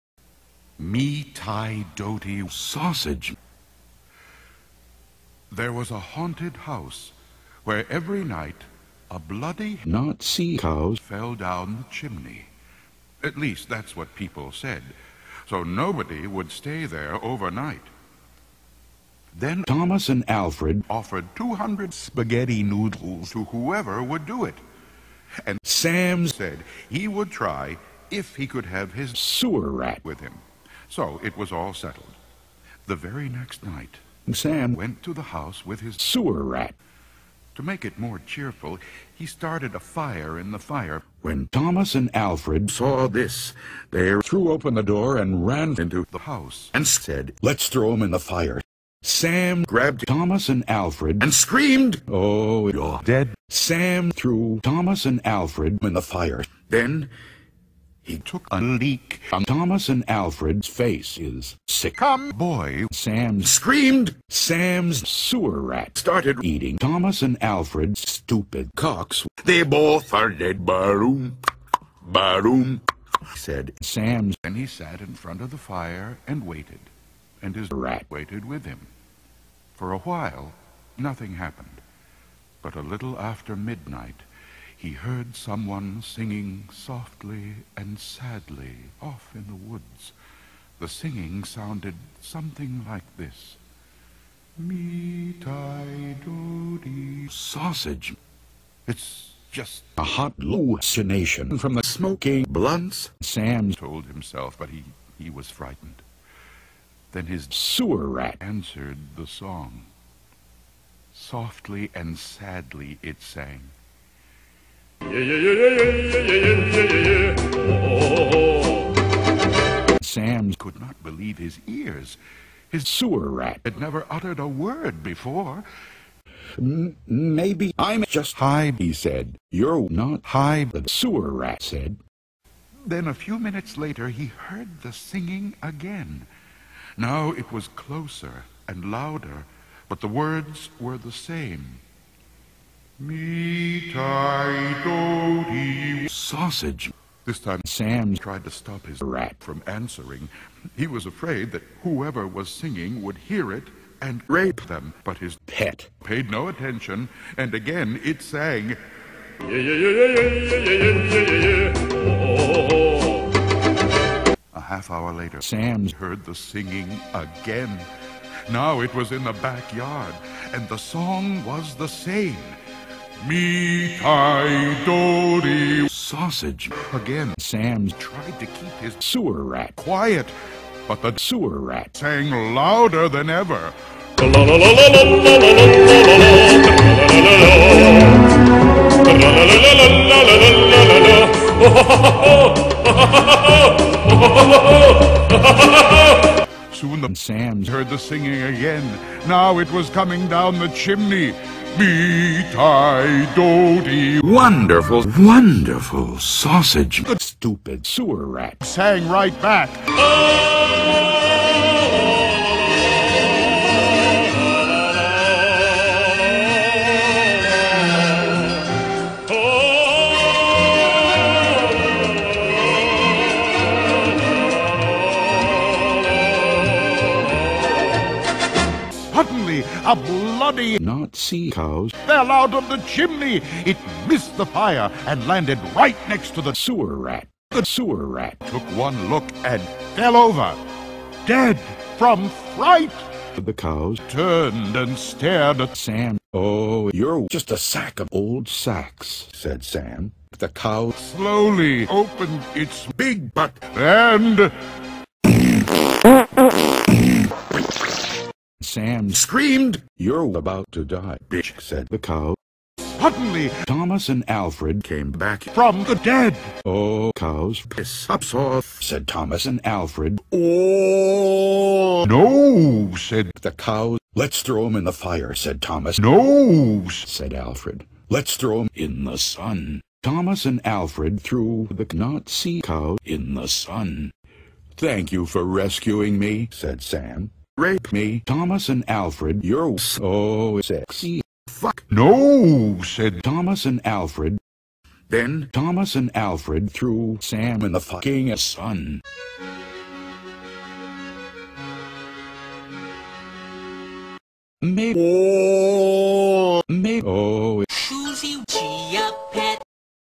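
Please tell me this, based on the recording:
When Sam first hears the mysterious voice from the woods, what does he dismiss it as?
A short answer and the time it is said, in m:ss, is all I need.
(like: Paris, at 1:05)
hot hallucination, at 1:40.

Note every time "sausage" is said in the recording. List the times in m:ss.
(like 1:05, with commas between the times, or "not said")
0:02, 1:37, 2:26, 2:55, 3:26.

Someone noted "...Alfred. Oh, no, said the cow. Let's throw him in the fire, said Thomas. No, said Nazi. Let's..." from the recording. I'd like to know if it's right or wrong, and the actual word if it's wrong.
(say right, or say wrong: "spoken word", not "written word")
wrong: "Alfred", not "Nazi".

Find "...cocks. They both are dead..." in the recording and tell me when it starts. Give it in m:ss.
1:08.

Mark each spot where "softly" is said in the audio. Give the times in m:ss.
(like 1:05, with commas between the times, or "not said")
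1:26, 1:51.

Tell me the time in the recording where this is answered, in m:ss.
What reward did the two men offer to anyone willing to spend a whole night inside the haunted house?
0:21.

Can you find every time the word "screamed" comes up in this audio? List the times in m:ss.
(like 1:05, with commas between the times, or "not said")
0:51, 1:03, 4:19.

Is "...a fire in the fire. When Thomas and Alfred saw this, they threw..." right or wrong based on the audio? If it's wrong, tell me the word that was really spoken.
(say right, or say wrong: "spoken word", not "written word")
right.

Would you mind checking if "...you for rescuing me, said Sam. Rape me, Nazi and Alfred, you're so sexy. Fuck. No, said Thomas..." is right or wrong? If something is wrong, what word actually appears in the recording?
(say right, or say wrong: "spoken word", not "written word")
wrong: "Thomas", not "Nazi".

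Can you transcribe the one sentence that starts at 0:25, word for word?
And Sam said he would try if he could have his sewer rat with him.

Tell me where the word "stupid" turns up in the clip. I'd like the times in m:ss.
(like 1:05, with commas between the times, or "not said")
1:08, 3:27.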